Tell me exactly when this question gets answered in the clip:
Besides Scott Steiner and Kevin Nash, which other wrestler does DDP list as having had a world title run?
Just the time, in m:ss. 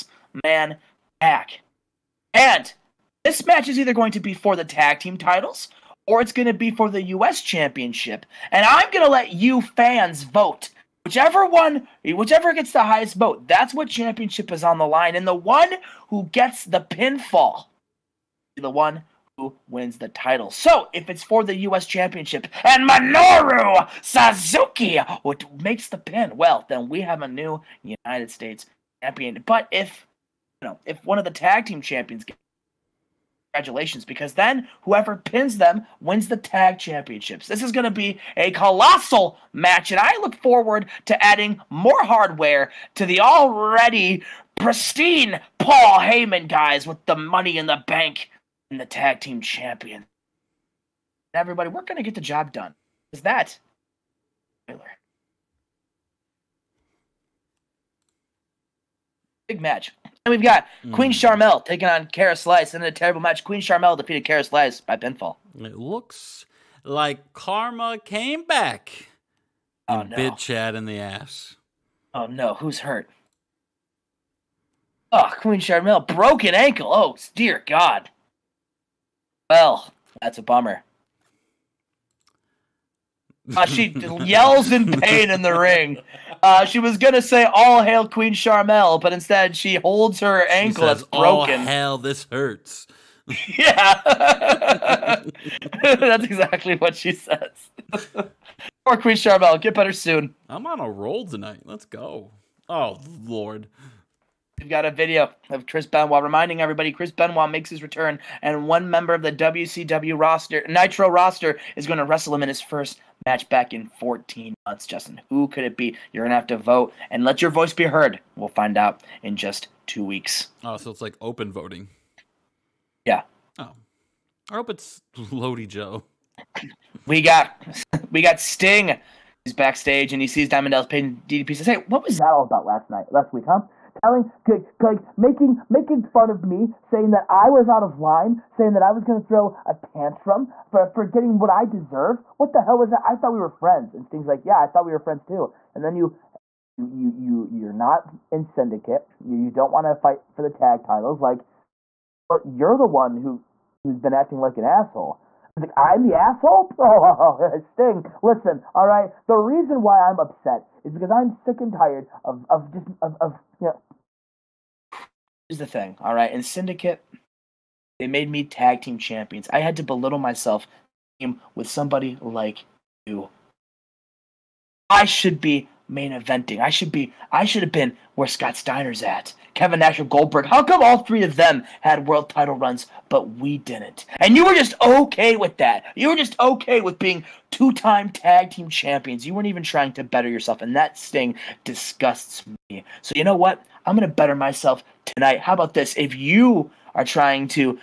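3:00.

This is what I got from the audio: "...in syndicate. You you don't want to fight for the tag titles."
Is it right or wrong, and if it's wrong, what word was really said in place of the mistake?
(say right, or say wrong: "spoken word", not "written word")
right.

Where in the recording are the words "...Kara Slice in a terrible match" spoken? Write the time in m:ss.
1:02.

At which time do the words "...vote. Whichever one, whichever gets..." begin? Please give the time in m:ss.
0:10.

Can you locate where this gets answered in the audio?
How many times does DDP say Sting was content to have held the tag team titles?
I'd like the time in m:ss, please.
3:07.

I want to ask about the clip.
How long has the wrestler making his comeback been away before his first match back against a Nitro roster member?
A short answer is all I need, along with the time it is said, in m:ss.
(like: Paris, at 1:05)
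14 months, at 1:53.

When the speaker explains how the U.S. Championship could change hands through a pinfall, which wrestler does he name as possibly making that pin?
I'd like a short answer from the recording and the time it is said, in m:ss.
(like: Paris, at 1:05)
Minoru Suzuki, at 0:22.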